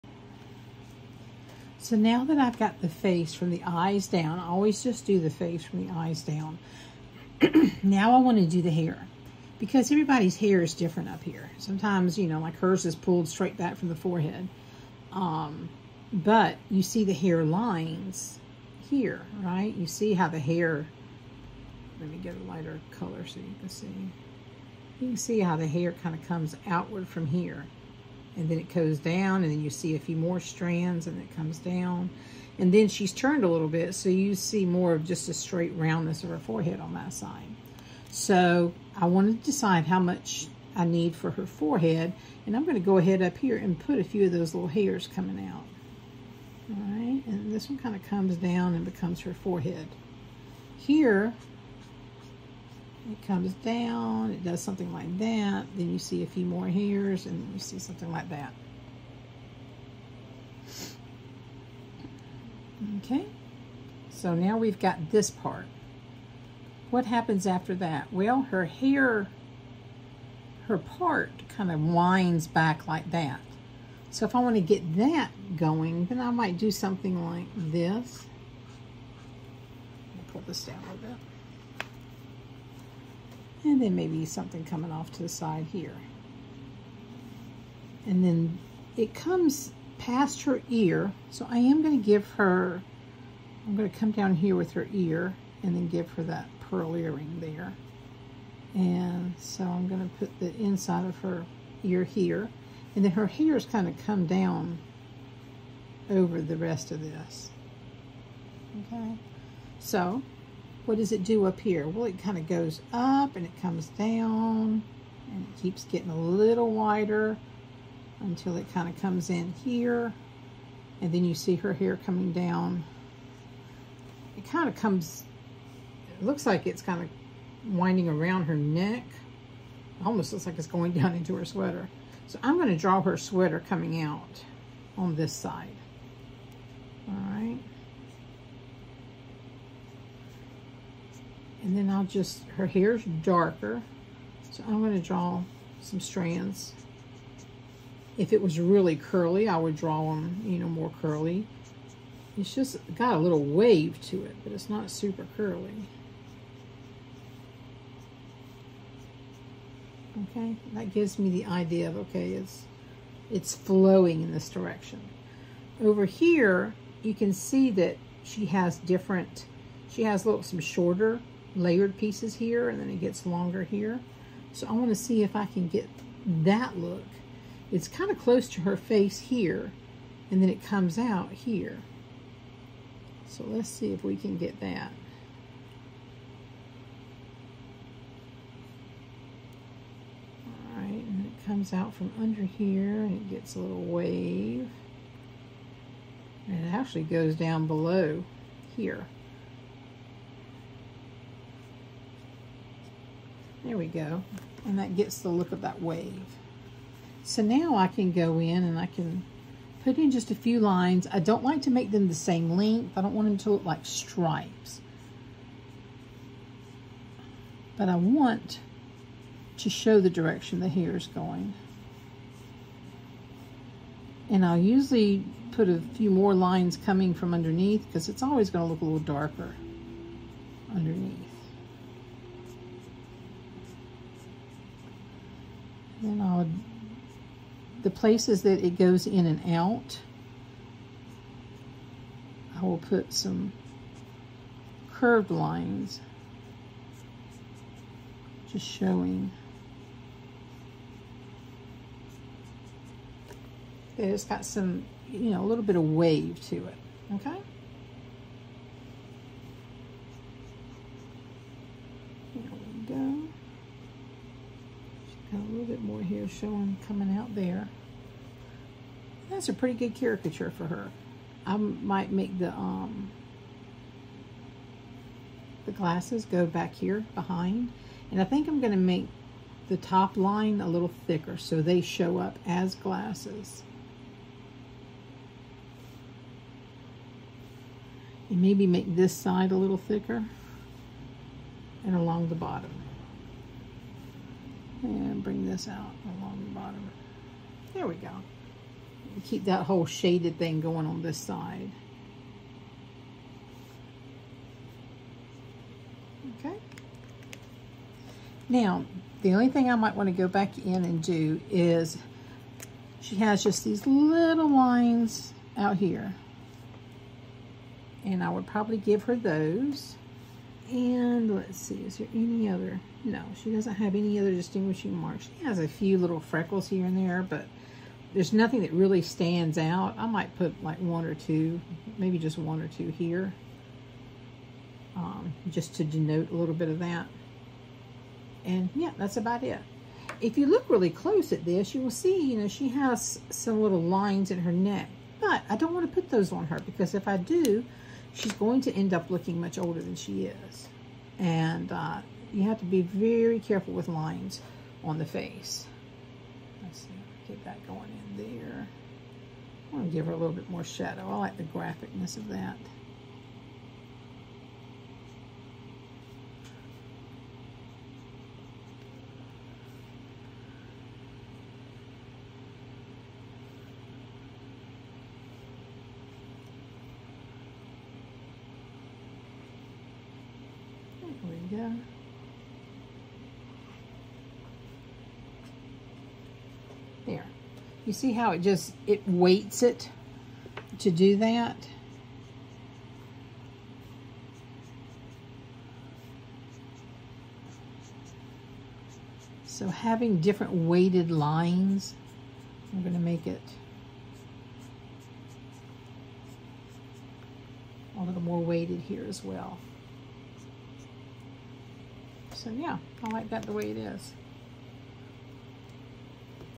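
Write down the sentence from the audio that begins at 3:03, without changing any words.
So let's see if we can get that.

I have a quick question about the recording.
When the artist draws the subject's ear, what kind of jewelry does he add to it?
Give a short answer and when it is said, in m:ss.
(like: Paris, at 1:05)
pearl earring, at 1:36.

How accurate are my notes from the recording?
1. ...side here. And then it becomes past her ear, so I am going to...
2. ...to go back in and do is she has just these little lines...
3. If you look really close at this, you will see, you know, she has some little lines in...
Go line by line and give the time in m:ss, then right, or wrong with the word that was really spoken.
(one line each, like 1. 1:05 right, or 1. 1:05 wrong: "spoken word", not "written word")
1. 1:25 wrong: "comes", not "becomes"
2. 5:10 right
3. 5:40 right.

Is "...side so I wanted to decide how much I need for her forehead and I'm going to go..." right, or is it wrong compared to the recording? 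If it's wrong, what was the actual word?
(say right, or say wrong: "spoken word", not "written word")
right.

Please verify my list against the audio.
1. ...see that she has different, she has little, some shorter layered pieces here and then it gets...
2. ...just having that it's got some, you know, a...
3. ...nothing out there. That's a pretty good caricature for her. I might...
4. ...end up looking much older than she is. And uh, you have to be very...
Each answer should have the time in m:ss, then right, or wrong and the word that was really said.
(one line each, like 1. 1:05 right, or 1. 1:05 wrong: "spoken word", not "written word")
1. 2:47 right
2. 4:08 wrong: "showing", not "having"
3. 4:26 wrong: "coming", not "nothing"
4. 5:48 right.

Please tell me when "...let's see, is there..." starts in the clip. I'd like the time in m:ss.
5:21.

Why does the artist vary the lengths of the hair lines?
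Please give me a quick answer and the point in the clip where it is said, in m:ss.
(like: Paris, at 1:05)
stripes, at 3:33.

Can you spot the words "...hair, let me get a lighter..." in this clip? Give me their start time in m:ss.
0:20.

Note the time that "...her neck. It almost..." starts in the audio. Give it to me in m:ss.
2:08.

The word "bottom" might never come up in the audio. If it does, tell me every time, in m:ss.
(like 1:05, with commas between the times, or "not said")
4:52, 4:56.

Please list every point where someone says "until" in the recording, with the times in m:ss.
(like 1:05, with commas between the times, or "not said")
1:58.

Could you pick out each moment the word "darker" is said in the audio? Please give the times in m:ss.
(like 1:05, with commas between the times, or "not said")
2:23, 3:48.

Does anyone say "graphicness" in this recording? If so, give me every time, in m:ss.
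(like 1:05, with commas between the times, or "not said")
6:01.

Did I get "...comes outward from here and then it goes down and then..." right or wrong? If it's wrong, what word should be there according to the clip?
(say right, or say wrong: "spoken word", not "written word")
right.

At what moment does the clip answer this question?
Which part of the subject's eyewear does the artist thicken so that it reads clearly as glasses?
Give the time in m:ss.
4:39.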